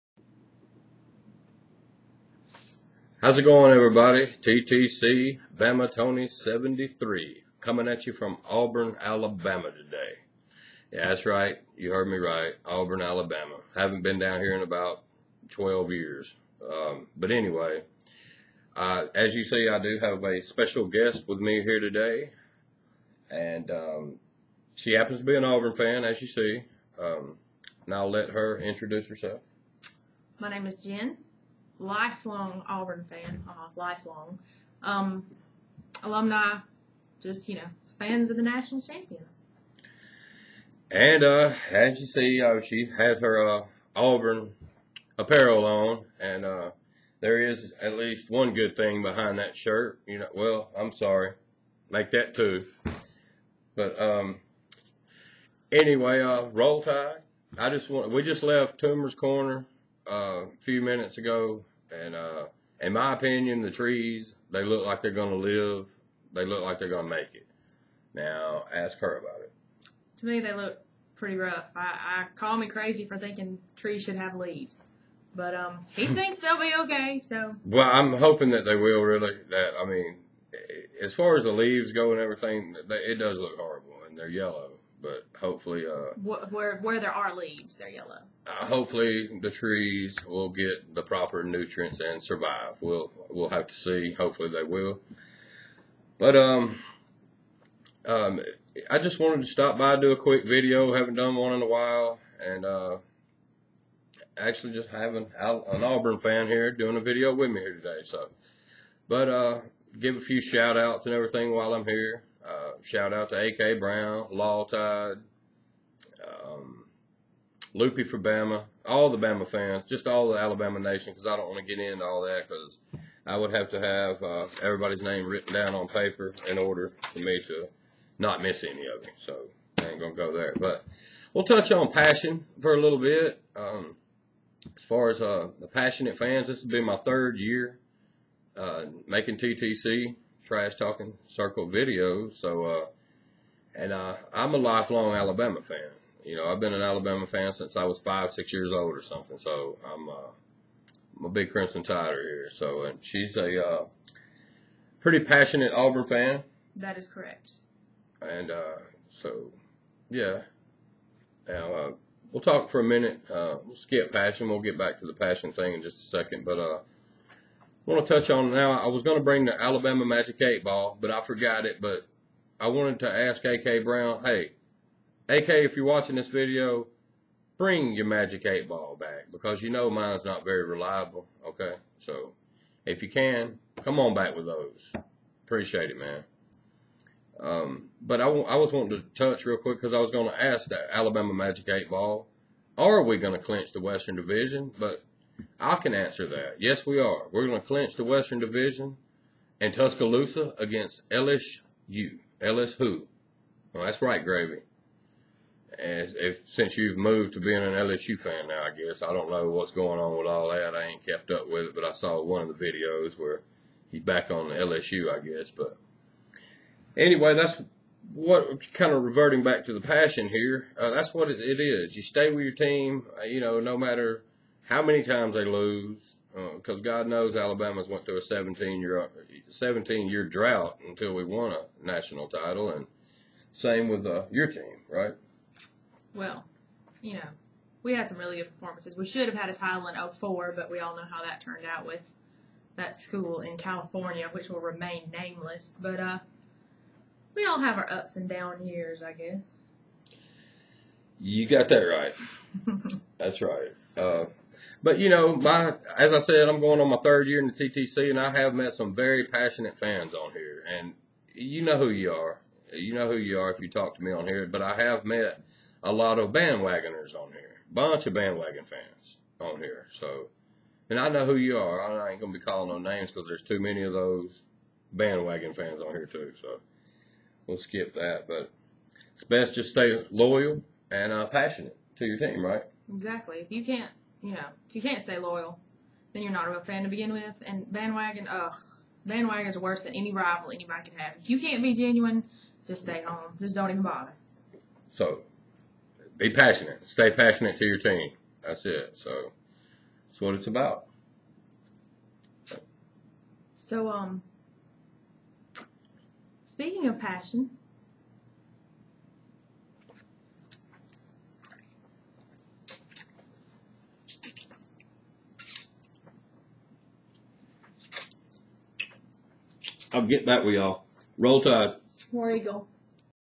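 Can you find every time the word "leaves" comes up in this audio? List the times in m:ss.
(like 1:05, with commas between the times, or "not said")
1:14, 1:21, 1:27.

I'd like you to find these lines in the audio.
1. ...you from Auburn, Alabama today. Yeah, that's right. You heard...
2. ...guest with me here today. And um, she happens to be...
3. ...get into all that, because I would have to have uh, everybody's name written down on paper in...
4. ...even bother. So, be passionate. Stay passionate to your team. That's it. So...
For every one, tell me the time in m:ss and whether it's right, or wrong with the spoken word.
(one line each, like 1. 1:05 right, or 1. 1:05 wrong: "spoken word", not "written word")
1. 0:08 right
2. 0:20 right
3. 2:01 right
4. 4:53 right.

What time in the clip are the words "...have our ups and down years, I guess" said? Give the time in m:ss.
4:07.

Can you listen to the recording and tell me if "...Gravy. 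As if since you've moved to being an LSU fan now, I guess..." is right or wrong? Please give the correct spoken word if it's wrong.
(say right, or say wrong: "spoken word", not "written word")
right.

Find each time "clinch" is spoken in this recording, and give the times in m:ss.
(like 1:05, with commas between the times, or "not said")
3:13, 3:17.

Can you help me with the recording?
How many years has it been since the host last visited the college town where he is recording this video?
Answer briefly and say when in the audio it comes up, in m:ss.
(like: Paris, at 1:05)
12, at 0:15.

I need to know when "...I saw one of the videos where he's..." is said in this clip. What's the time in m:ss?
3:31.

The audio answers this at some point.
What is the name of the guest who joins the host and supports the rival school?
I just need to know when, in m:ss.
0:30.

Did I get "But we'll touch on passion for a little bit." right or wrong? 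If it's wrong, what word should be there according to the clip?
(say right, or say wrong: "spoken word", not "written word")
right.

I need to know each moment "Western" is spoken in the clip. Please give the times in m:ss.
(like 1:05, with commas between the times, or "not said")
3:13, 3:18.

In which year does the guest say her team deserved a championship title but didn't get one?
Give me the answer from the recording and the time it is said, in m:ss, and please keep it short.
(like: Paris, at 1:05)
2004, at 4:00.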